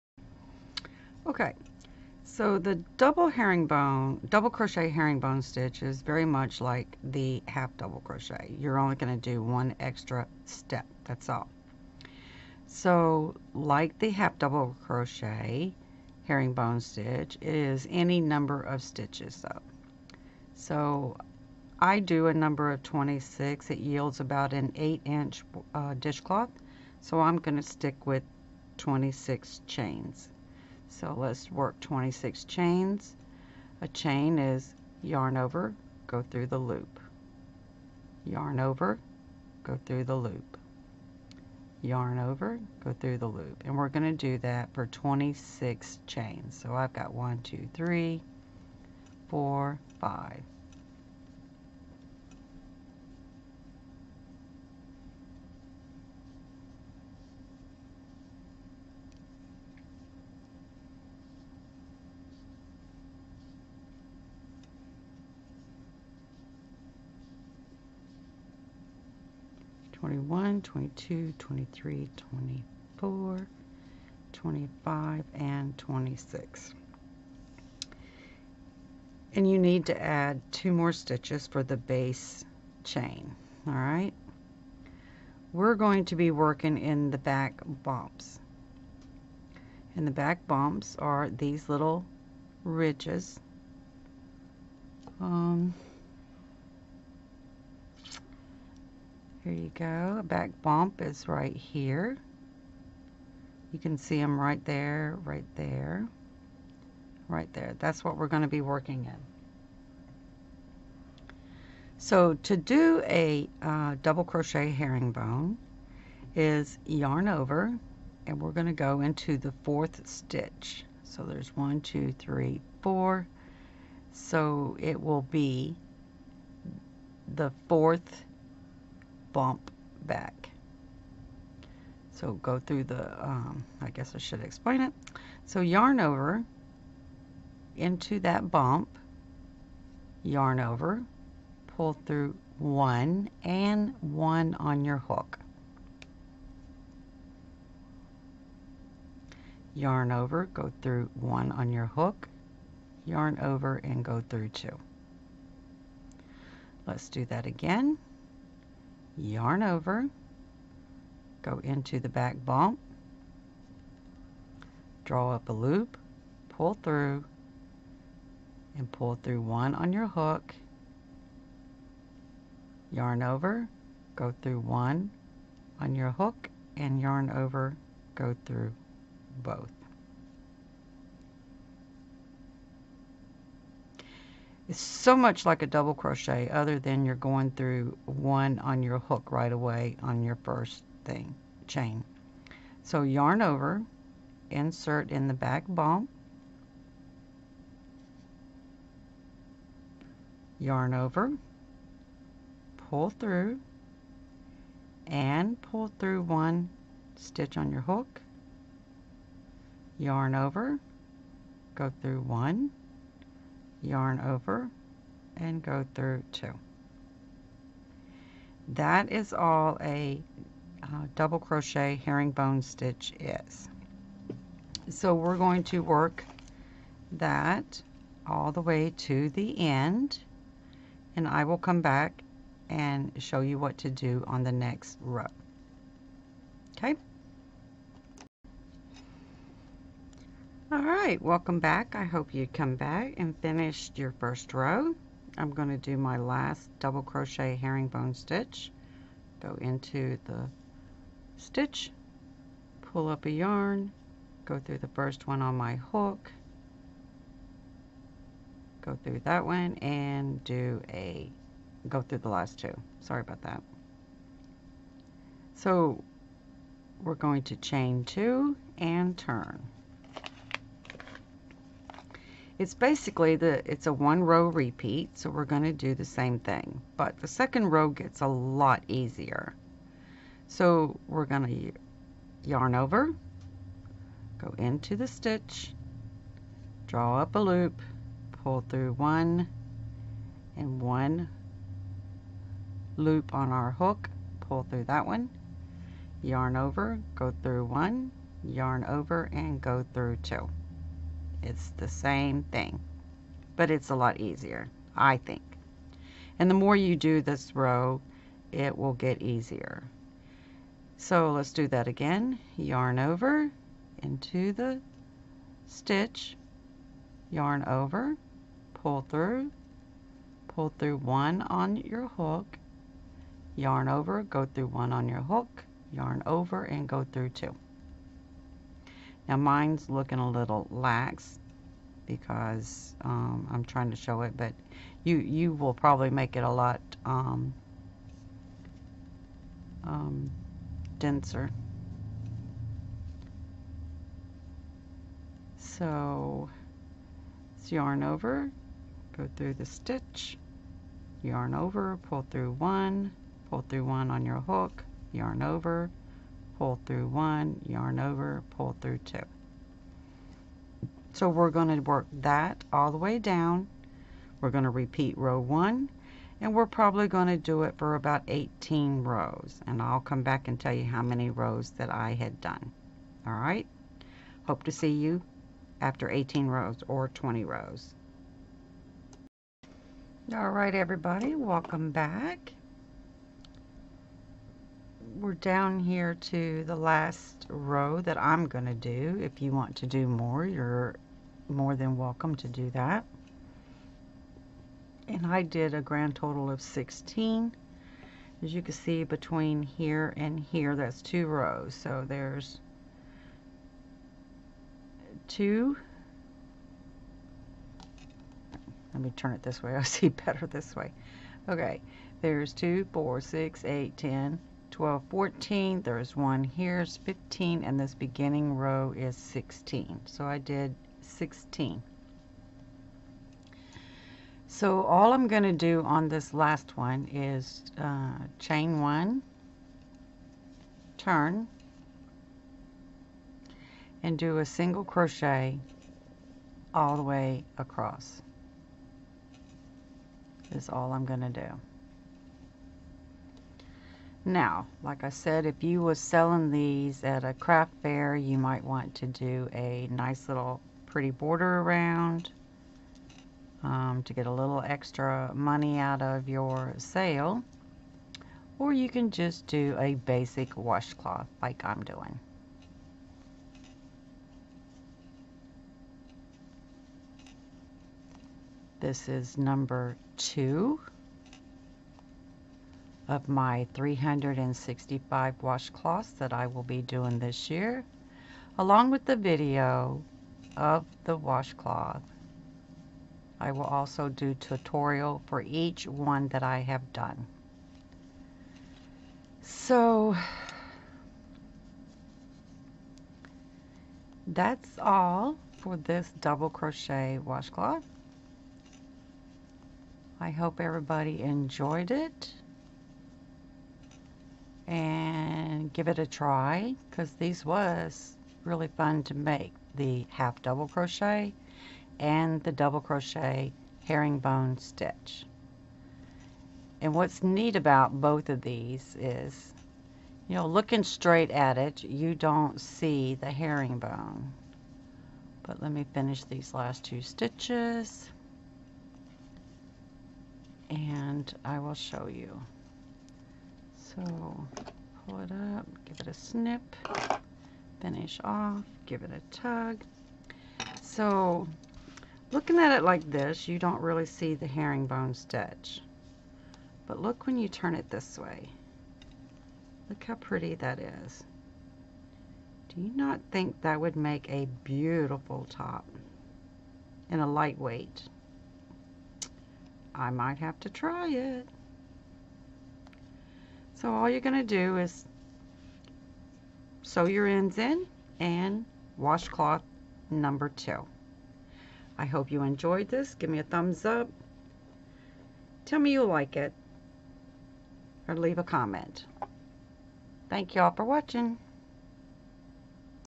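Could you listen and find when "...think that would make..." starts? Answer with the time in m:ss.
9:13.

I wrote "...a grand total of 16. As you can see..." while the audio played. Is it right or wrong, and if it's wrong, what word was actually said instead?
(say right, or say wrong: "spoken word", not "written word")
right.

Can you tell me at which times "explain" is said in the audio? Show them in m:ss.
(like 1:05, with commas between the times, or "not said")
2:14.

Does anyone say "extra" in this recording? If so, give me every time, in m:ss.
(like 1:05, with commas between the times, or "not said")
0:09, 7:34.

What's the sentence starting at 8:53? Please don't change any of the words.
So pull it up, give it a snip, finish off, give it a tug.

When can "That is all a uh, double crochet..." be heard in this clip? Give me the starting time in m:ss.
3:38.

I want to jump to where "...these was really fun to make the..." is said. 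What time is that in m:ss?
8:27.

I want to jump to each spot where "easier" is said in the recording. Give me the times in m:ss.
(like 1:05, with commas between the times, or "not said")
4:38, 5:04, 5:09.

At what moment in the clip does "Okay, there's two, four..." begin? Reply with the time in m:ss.
6:51.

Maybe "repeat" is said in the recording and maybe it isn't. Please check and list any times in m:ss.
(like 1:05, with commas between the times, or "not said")
4:34, 6:04.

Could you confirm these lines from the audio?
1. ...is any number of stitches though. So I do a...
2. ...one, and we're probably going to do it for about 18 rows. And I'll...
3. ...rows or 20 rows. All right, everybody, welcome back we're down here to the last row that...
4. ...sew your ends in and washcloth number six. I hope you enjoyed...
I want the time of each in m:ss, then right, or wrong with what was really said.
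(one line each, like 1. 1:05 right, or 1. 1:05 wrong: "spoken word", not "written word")
1. 0:17 right
2. 6:05 right
3. 6:16 right
4. 9:26 wrong: "two", not "six".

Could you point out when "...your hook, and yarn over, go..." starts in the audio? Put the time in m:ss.
2:55.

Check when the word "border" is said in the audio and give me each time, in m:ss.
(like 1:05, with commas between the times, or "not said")
7:31.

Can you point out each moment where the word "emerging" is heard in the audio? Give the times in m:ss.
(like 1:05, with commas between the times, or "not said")
not said.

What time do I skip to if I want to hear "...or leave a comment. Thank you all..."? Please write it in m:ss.
9:38.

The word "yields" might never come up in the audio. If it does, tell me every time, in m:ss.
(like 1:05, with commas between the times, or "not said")
0:23.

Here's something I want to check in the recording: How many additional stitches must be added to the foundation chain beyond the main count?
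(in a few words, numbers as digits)
2.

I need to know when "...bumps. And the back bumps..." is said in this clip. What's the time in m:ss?
1:27.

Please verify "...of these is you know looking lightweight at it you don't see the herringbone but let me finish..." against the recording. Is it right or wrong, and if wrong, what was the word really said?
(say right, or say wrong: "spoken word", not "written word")
wrong: "straight", not "lightweight".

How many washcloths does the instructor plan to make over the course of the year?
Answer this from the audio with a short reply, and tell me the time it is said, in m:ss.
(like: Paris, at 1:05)
365, at 7:53.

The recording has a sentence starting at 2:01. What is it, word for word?
So there's one, two, three, four.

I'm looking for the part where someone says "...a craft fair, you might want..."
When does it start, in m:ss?
7:27.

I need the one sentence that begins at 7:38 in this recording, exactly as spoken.
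Or you can just do a basic washcloth like I'm doing.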